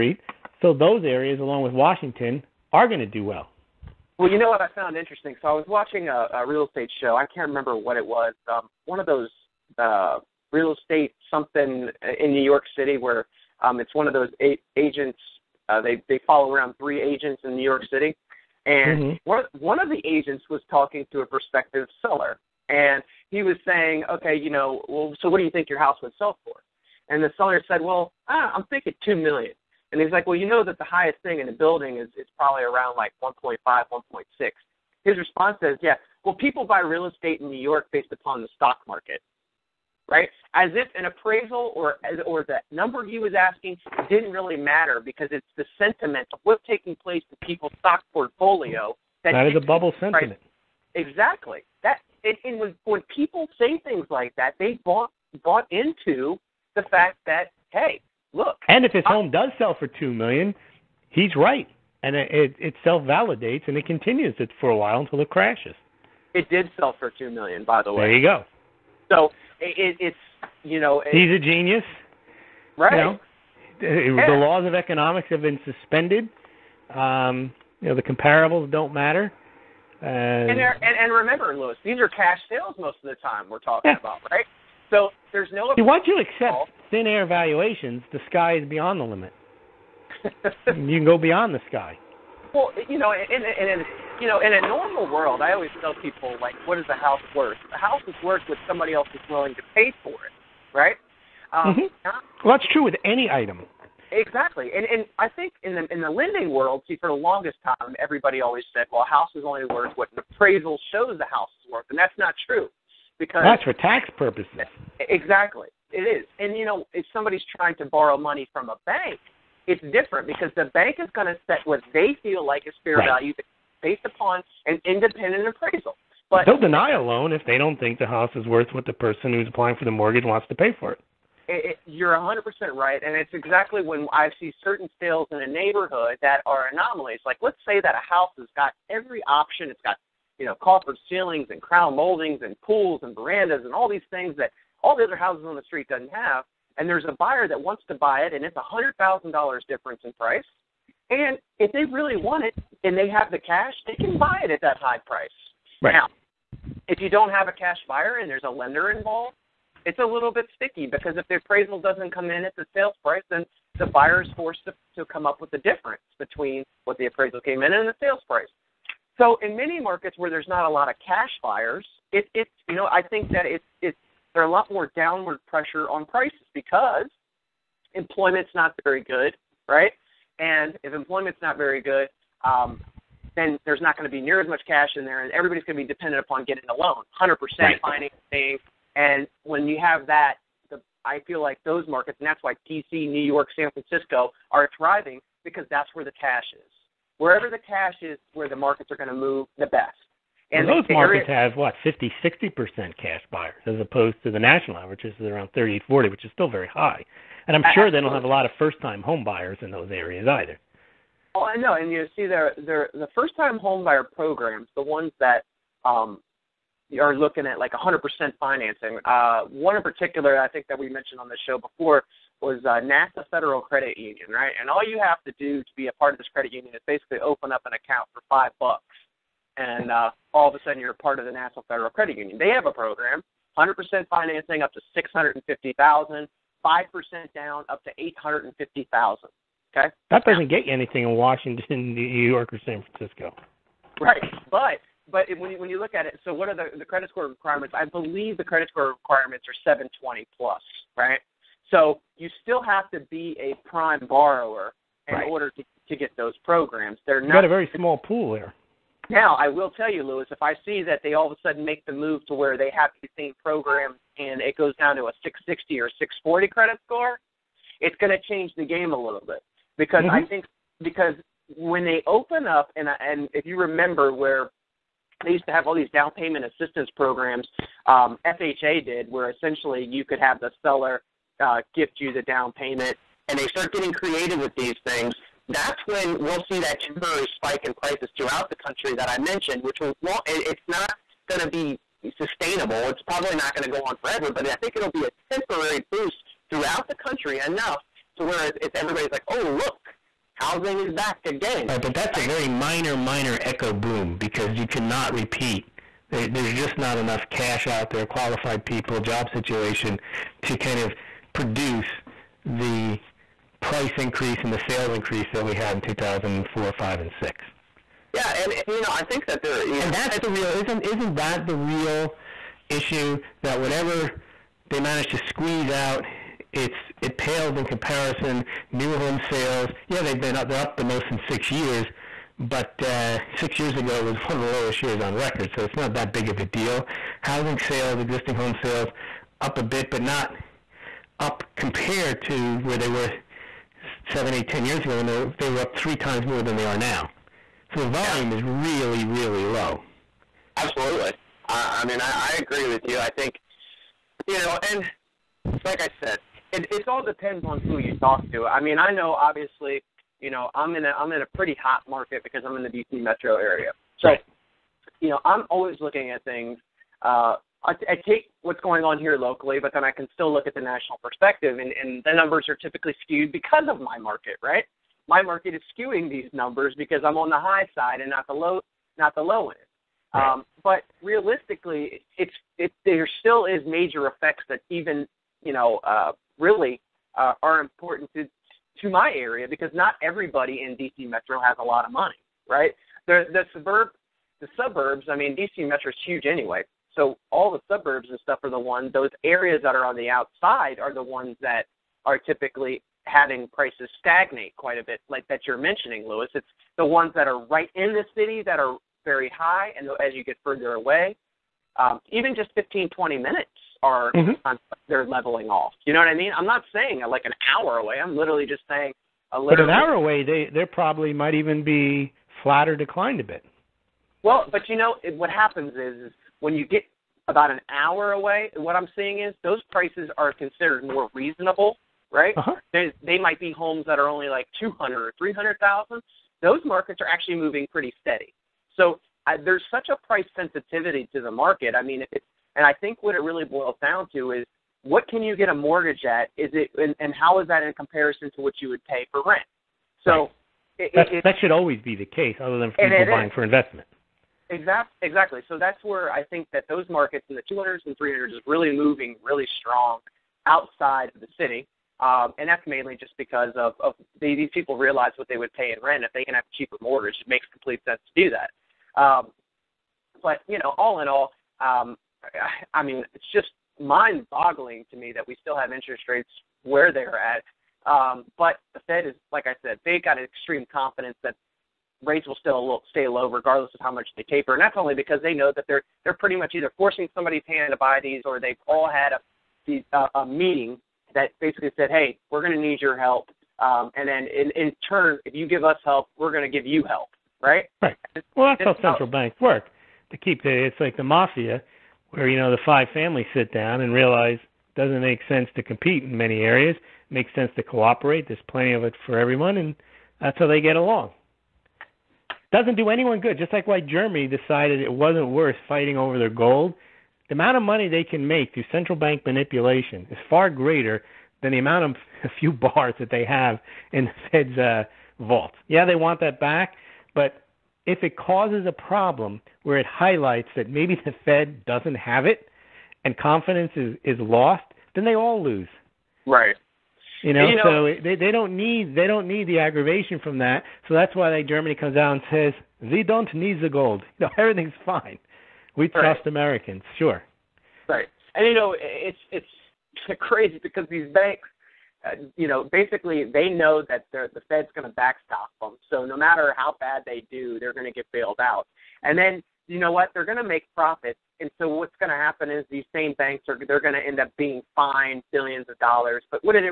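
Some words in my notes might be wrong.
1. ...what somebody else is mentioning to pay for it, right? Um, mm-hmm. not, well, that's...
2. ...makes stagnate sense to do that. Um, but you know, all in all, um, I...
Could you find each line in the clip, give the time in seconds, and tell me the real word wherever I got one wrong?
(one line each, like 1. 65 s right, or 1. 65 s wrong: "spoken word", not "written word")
1. 98 s wrong: "willing", not "mentioning"
2. 467 s wrong: "complete", not "stagnate".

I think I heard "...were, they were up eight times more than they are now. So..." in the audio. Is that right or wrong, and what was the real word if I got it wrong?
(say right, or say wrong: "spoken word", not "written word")
wrong: "three", not "eight".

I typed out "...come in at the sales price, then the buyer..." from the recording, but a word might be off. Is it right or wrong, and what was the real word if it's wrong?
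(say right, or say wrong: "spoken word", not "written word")
right.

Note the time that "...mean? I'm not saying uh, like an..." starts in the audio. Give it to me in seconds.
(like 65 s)
416 s.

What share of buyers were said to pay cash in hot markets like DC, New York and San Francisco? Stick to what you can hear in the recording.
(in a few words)
50 to 60 percent.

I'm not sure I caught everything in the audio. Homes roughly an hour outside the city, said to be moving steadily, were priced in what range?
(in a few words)
200,000 to 300,000.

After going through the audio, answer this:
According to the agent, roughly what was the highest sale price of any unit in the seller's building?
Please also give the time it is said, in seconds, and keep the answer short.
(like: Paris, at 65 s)
1.5 to 1.6 million, at 33 s.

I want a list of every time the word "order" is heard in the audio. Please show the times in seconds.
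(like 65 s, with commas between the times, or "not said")
255 s.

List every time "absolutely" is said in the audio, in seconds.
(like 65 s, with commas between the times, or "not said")
207 s, 350 s.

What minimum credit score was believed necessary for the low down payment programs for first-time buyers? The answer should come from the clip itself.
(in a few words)
720.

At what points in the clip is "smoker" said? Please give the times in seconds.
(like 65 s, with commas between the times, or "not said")
not said.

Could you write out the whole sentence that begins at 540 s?
So that's why like Germany comes out and says they don't need the gold.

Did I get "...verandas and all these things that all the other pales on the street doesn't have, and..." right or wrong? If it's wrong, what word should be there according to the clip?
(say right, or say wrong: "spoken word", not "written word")
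wrong: "houses", not "pales".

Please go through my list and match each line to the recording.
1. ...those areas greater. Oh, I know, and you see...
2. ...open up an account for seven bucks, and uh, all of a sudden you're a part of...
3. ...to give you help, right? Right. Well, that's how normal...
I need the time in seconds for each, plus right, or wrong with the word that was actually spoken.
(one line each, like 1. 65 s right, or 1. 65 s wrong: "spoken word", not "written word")
1. 209 s wrong: "either", not "greater"
2. 227 s wrong: "five", not "seven"
3. 496 s wrong: "central", not "normal".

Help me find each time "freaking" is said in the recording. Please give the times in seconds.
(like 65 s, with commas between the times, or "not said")
not said.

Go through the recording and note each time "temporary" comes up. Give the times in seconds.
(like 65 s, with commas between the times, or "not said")
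286 s, 295 s.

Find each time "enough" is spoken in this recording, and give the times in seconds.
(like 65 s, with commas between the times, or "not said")
297 s, 306 s.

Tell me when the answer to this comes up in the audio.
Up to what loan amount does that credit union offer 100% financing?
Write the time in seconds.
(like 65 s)
234 s.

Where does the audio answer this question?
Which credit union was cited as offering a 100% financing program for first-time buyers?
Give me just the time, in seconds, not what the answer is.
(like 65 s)
222 s.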